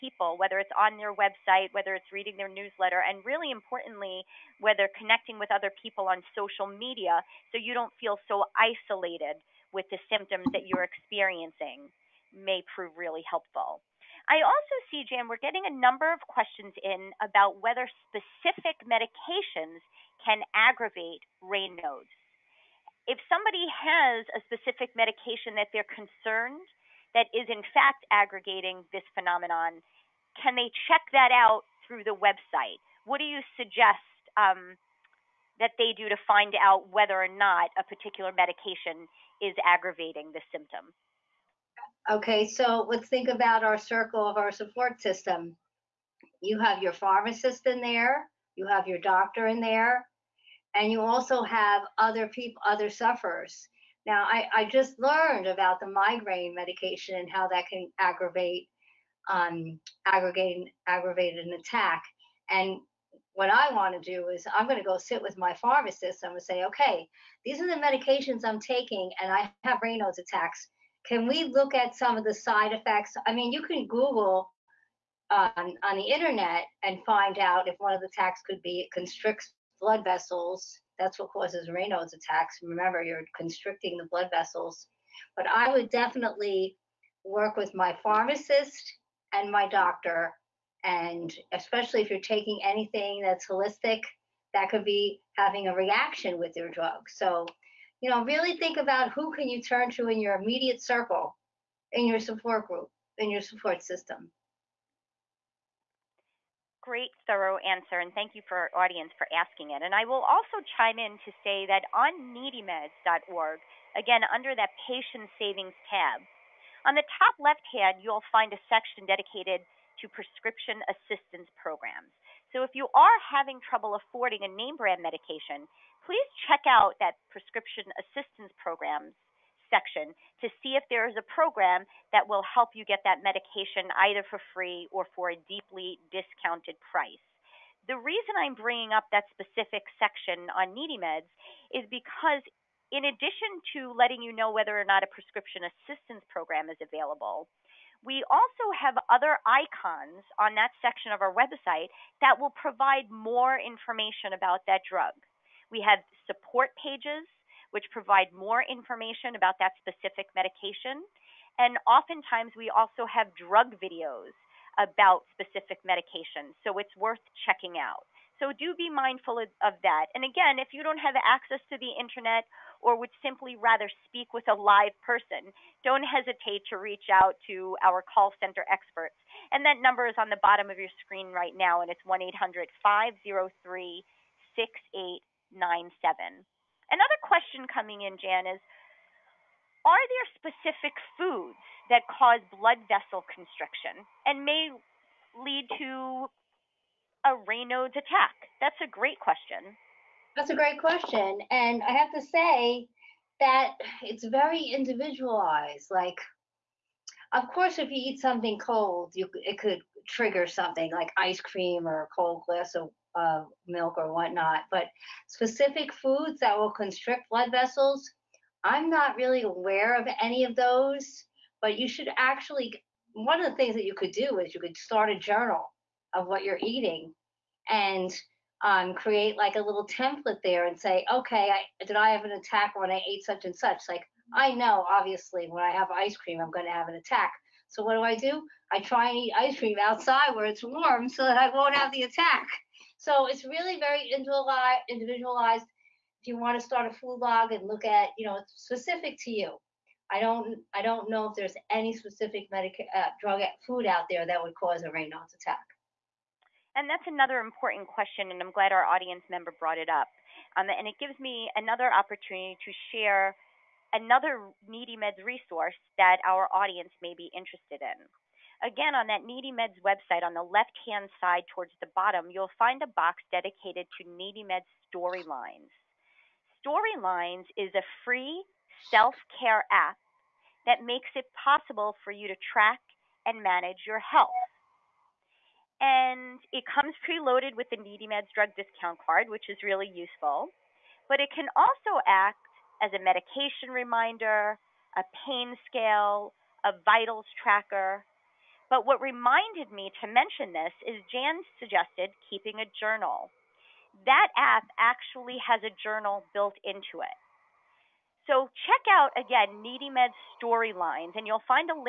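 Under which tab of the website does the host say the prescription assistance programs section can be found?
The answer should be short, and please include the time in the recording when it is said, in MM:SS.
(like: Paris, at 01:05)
patient savings, at 01:54.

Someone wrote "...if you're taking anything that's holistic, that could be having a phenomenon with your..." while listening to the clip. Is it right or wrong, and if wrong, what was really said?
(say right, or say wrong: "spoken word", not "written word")
wrong: "reaction", not "phenomenon".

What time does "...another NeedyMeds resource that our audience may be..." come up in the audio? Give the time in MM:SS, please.
04:23.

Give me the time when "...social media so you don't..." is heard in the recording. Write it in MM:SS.
00:06.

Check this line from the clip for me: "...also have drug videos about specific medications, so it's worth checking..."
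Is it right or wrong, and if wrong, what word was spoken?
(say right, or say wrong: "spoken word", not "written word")
right.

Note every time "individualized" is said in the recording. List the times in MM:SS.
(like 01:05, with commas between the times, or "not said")
03:24, 04:04.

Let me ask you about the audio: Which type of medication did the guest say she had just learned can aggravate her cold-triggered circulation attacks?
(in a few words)
migraine medication.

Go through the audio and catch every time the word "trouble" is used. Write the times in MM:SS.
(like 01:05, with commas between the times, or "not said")
02:03.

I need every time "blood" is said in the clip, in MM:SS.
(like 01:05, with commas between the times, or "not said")
01:19, 01:24, 03:12, 03:37.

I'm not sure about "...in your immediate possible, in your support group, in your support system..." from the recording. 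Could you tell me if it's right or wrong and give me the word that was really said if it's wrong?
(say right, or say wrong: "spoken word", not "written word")
wrong: "circle", not "possible".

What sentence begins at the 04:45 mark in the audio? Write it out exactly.
And it comes preloaded with the NeedyMeds drug discount card, which is really useful.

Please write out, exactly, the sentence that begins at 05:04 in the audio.
That app actually has a journal built into it.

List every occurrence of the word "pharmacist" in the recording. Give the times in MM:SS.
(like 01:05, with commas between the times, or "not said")
00:46, 01:05, 01:28.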